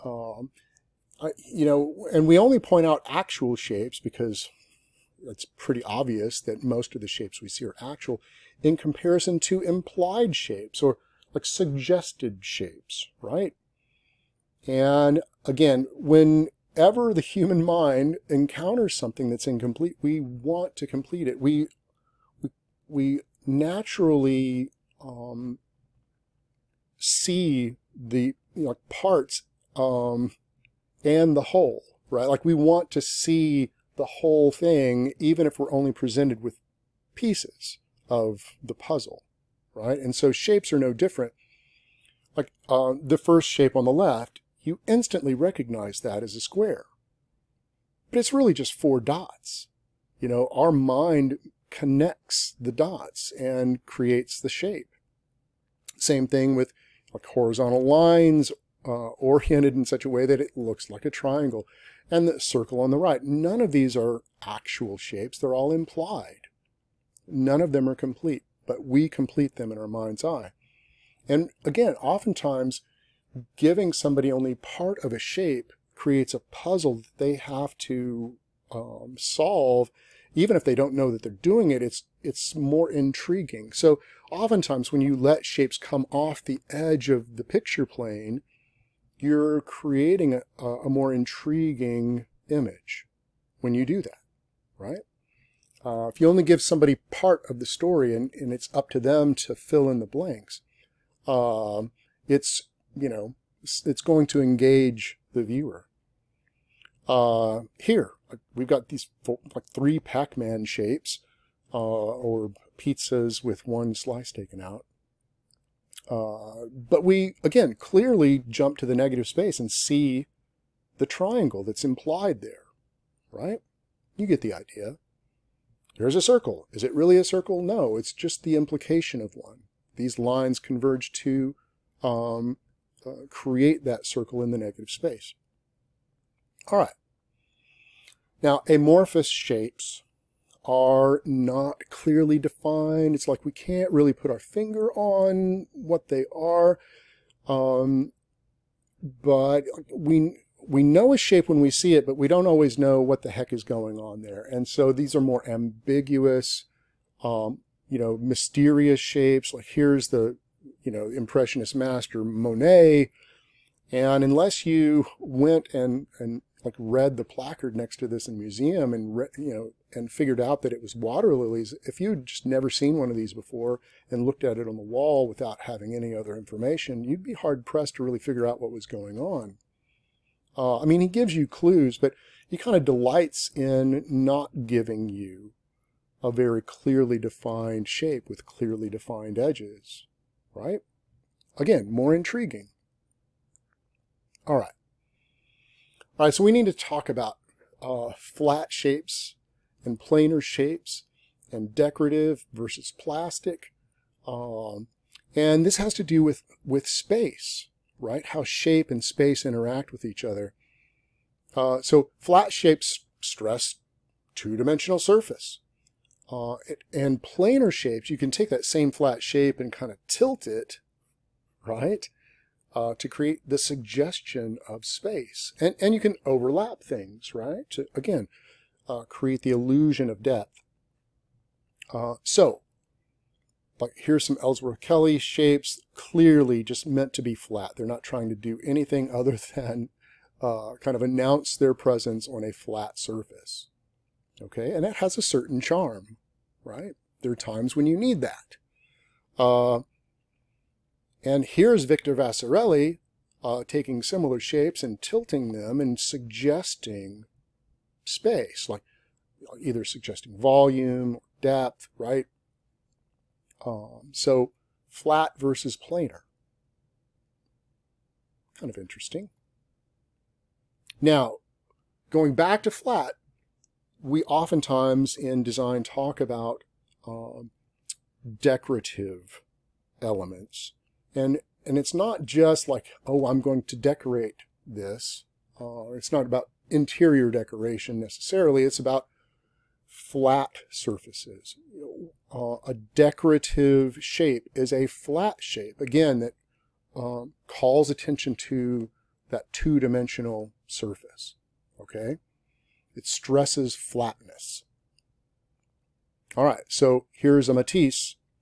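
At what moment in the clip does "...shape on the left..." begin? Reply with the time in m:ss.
0:43.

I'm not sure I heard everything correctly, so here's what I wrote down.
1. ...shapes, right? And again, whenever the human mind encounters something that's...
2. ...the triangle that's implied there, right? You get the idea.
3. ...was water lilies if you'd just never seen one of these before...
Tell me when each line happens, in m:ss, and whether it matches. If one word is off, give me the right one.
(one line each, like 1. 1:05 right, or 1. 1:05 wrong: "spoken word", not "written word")
1. 0:12 right
2. 2:00 right
3. 2:50 right.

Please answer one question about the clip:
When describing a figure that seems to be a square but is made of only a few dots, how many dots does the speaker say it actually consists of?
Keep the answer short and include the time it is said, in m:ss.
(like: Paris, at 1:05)
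4, at 0:48.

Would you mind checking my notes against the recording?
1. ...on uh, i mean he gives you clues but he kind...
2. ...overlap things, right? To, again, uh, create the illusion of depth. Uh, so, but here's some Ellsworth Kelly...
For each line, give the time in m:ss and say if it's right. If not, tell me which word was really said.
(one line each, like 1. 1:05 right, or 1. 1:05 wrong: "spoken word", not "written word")
1. 2:59 right
2. 3:46 right.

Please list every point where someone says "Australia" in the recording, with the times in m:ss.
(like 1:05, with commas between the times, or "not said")
not said.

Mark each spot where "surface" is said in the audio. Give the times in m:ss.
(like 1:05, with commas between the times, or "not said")
3:34, 4:02, 4:50, 5:00.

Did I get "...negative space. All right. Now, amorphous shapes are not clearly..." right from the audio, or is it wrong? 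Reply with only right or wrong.
right.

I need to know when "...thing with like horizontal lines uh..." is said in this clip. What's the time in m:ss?
0:56.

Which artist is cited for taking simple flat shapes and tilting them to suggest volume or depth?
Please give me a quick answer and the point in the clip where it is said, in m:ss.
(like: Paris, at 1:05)
Victor Vasarely, at 4:11.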